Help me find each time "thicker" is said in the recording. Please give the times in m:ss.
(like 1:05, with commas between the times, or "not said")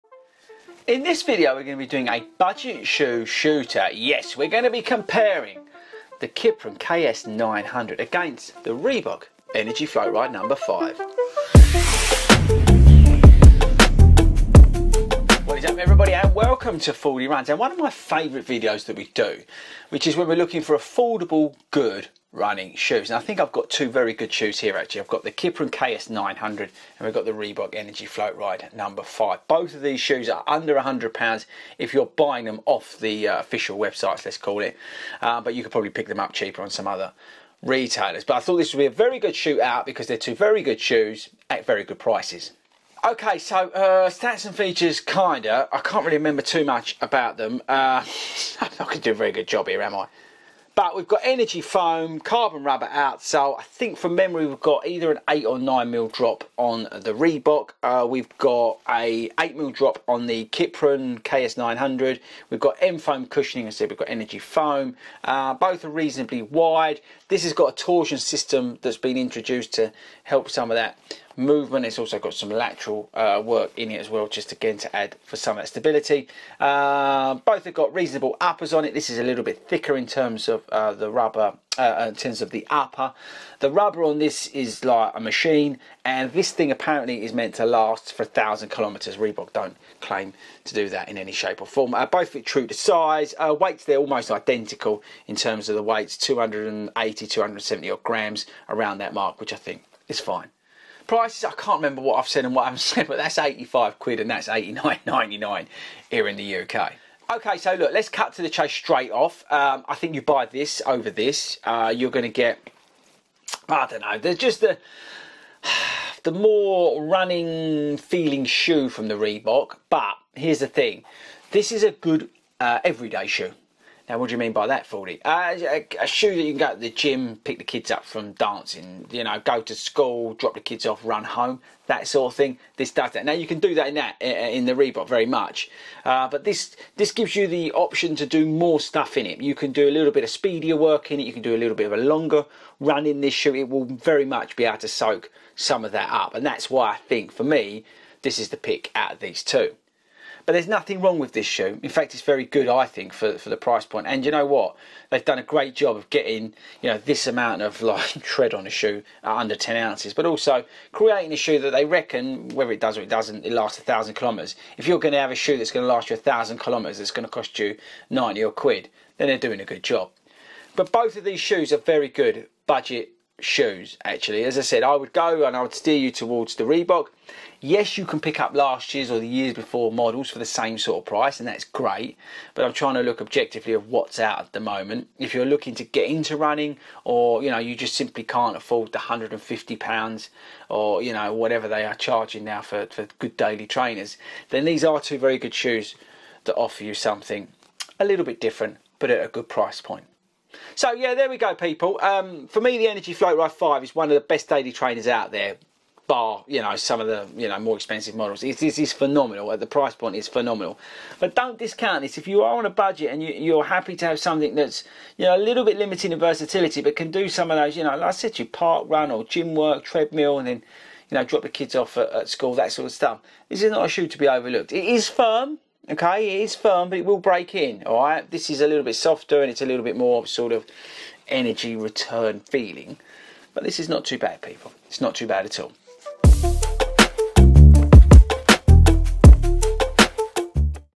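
1:19.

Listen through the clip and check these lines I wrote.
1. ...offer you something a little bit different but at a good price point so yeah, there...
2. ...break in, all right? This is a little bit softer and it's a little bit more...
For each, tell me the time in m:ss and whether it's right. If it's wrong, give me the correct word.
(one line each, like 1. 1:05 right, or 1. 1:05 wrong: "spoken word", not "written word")
1. 3:16 right
2. 3:47 right.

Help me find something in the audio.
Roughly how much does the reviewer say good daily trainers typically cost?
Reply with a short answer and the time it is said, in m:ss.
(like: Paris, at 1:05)
150 pounds, at 3:08.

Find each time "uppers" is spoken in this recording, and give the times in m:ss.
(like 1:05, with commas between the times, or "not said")
1:18, 1:22.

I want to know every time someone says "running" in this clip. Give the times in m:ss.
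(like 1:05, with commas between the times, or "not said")
0:22, 1:57, 3:06.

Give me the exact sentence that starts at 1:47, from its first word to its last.
Okay, so look, let's cut to the chase straight off.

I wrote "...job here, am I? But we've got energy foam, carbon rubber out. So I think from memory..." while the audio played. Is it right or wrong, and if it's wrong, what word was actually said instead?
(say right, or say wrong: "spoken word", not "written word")
right.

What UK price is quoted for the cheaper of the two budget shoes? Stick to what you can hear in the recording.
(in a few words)
£85.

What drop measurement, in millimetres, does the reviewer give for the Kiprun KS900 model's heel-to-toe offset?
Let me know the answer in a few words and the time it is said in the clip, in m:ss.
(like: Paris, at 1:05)
8, at 0:59.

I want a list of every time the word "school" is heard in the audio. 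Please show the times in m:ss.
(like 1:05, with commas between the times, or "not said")
2:09, 3:42.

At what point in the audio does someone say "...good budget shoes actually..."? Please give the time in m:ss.
2:52.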